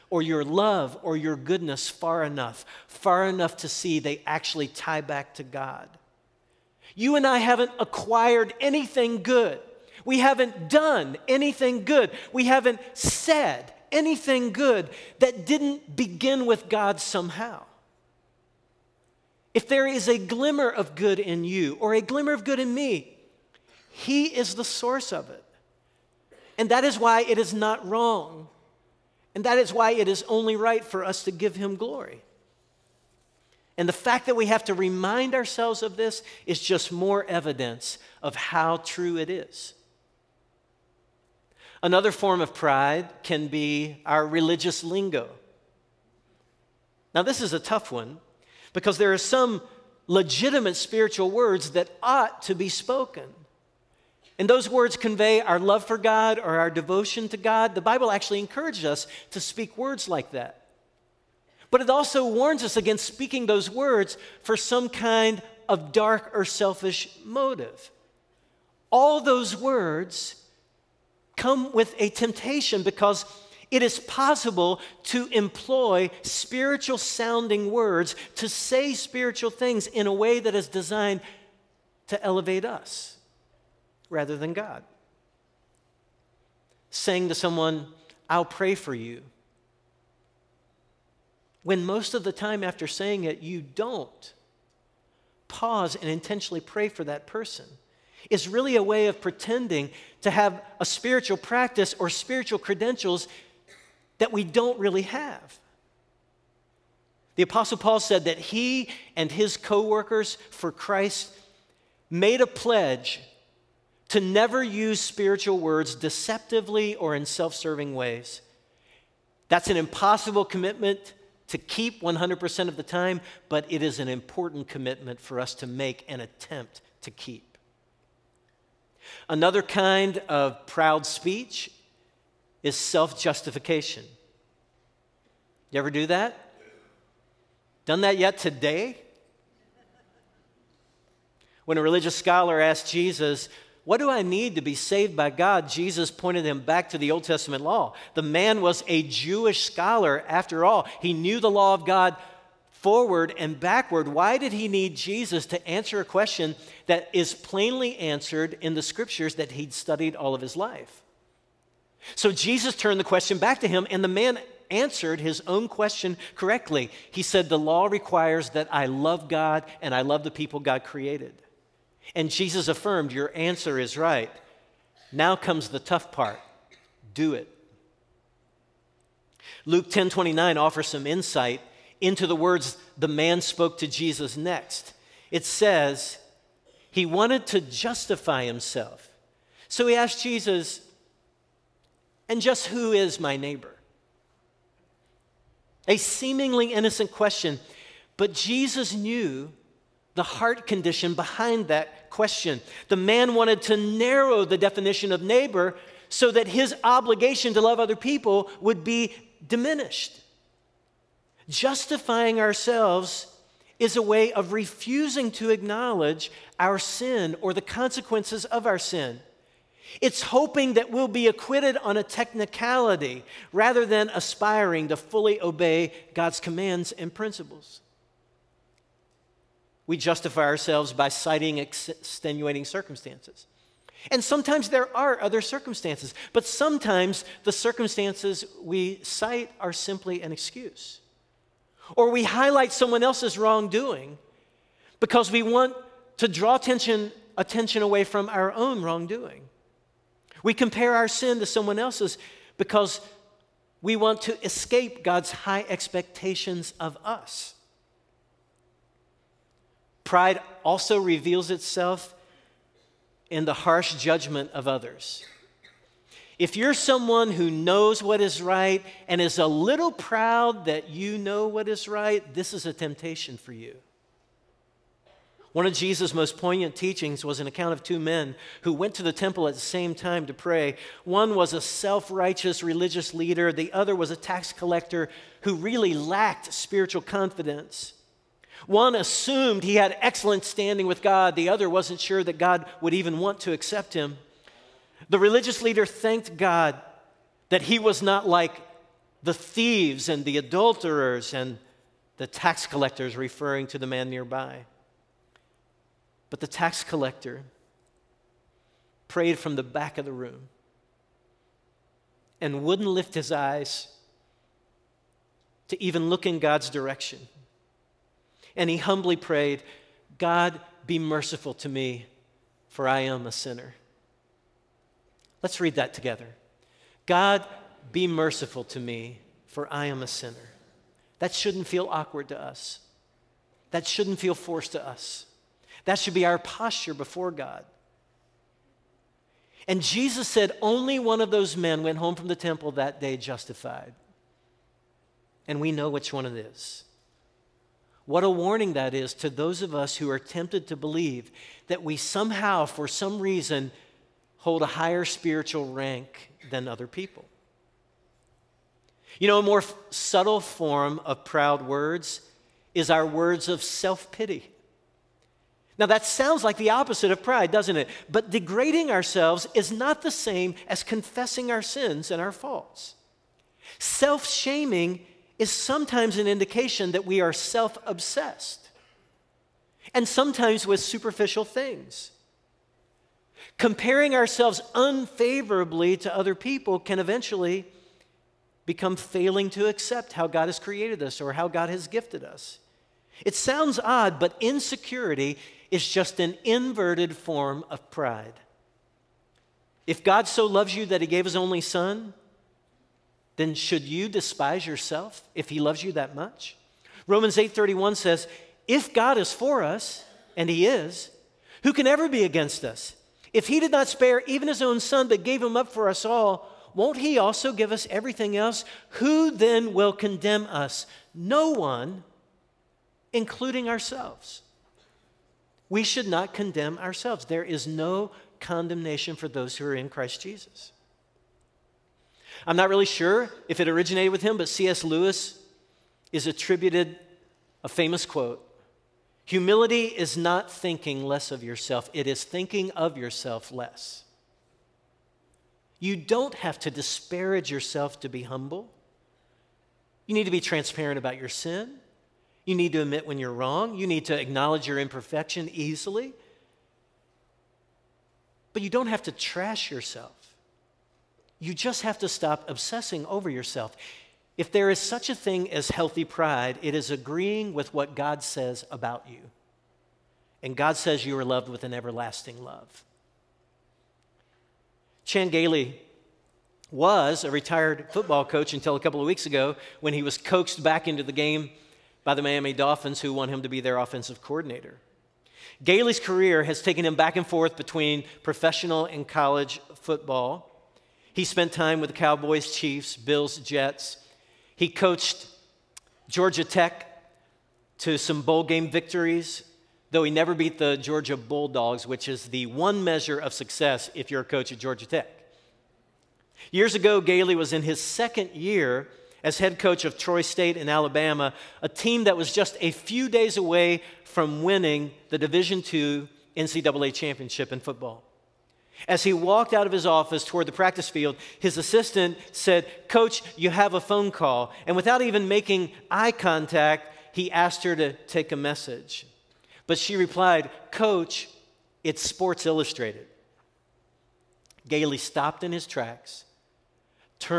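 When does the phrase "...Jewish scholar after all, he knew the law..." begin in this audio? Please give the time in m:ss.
2:29.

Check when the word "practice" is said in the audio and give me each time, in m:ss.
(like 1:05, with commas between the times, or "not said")
1:41, 8:40.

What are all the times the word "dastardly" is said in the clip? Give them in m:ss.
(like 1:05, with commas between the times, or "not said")
not said.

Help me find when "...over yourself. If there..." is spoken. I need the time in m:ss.
7:43.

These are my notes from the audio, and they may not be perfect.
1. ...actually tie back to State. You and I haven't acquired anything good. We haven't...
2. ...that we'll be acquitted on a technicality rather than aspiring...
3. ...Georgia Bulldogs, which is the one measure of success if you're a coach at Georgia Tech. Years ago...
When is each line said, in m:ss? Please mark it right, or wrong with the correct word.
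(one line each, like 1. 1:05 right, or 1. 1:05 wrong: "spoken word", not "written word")
1. 0:04 wrong: "God", not "State"
2. 3:40 right
3. 8:20 right.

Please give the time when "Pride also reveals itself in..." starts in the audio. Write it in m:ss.
4:20.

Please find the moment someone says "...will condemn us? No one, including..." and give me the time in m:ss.
6:59.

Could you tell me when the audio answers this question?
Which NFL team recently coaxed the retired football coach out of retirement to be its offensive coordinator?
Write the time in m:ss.
8:02.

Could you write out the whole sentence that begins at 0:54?
And those words convey our love for God or our devotion to God.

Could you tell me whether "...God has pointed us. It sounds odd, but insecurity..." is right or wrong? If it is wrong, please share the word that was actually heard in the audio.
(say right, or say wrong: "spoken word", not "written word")
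wrong: "gifted", not "pointed".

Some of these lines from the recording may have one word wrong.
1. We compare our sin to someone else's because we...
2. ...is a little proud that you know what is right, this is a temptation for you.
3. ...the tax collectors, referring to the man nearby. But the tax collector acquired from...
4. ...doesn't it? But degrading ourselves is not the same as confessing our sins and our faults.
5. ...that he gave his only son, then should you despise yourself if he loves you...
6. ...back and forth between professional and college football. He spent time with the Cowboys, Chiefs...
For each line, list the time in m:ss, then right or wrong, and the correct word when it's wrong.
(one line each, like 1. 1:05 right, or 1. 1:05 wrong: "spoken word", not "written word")
1. 4:10 right
2. 4:29 right
3. 5:02 wrong: "prayed", not "acquired"
4. 6:07 right
5. 6:40 right
6. 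8:06 right.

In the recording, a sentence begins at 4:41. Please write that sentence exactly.
One was a self righteous religious leader, the other was a tax collector who really lacked spiritual confidence.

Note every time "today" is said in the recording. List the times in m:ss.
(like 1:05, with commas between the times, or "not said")
2:18.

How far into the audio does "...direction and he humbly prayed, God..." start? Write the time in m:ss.
5:16.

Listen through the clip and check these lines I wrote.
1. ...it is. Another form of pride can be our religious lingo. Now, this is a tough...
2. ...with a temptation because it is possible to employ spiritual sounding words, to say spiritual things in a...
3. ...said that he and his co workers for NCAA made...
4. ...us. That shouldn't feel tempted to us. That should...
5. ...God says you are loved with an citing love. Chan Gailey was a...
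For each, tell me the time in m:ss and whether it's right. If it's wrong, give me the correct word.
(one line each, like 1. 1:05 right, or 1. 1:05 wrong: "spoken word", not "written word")
1. 0:39 right
2. 1:11 right
3. 1:47 wrong: "Christ", not "NCAA"
4. 5:32 wrong: "forced", not "tempted"
5. 7:50 wrong: "everlasting", not "citing".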